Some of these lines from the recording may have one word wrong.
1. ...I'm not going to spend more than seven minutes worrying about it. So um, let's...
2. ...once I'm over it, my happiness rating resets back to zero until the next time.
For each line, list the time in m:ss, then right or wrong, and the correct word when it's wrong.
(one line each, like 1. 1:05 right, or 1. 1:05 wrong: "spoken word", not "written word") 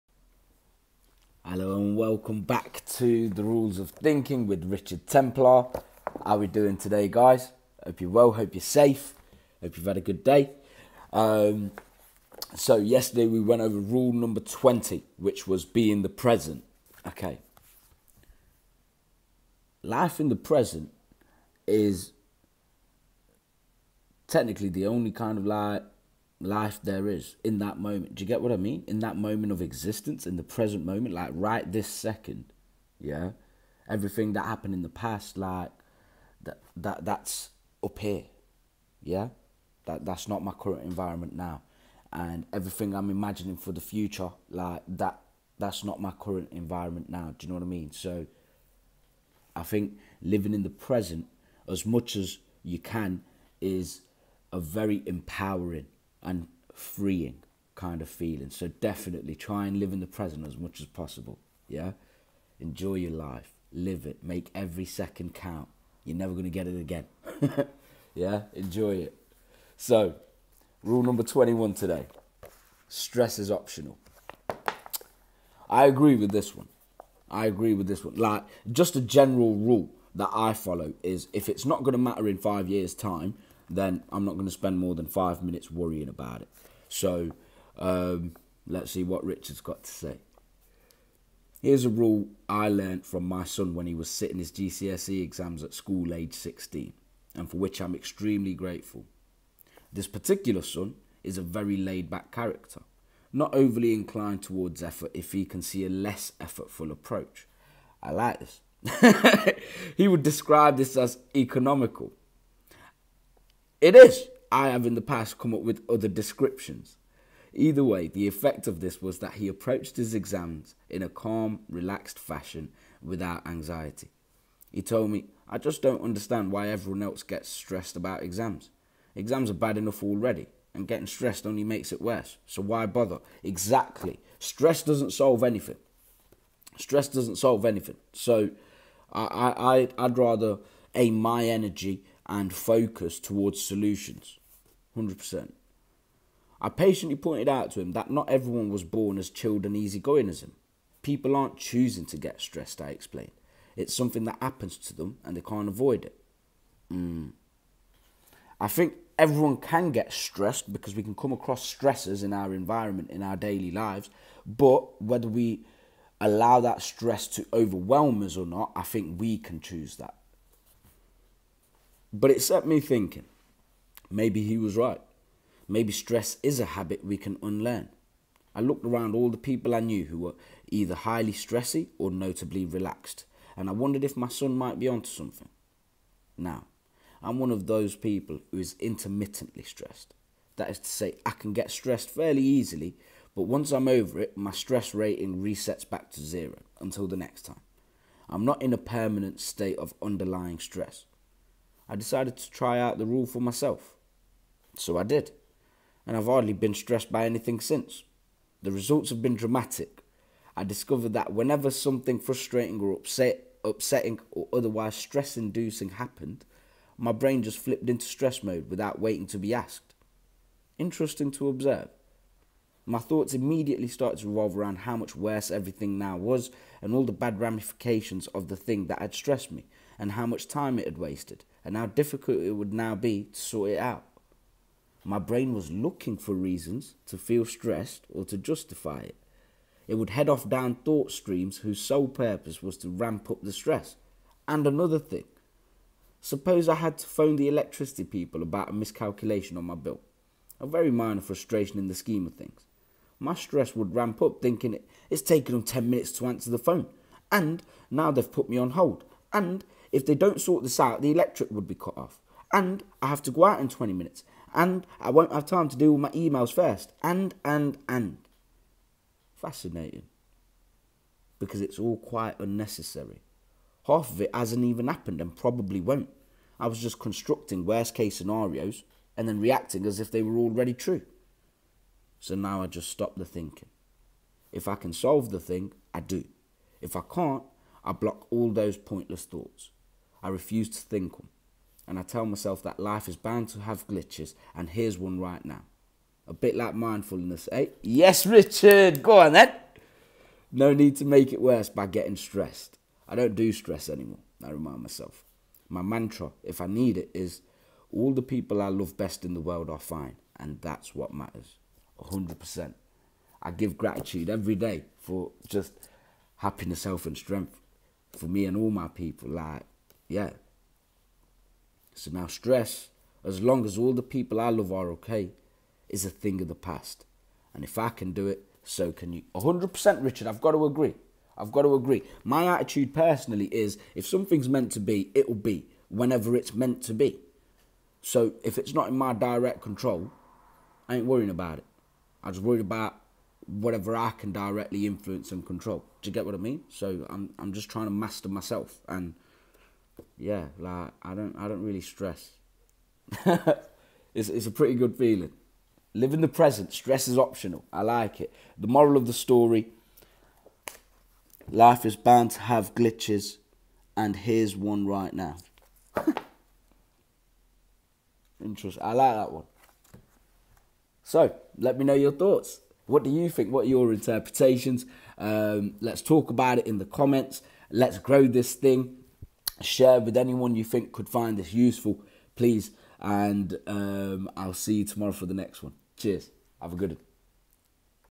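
1. 1:24 wrong: "five", not "seven"
2. 3:13 wrong: "stress", not "happiness".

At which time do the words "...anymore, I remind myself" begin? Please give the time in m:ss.
5:03.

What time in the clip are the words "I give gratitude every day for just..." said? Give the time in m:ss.
5:13.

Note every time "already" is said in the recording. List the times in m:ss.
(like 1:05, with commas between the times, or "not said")
2:10, 4:40.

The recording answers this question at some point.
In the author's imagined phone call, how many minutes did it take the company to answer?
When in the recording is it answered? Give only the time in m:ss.
4:15.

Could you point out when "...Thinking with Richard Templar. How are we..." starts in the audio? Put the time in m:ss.
0:03.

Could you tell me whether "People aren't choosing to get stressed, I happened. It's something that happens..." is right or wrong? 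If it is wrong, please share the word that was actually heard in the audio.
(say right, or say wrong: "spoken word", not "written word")
wrong: "explained", not "happened".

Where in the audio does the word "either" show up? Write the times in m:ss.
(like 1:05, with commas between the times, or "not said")
1:57, 3:00.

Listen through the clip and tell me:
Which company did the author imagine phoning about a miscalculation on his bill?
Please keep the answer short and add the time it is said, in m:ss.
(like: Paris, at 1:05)
The electricity people, at 4:07.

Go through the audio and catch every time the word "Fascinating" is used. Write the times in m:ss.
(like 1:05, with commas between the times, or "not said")
4:29.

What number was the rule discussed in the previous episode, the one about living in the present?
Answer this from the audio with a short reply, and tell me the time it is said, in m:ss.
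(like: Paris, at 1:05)
20, at 0:13.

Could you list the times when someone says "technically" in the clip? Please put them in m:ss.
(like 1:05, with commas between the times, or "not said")
0:24.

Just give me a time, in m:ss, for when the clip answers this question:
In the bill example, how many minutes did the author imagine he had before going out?
4:23.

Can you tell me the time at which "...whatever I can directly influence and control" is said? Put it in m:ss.
5:43.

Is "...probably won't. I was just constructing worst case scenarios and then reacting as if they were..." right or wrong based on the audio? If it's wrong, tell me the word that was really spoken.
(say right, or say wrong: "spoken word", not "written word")
right.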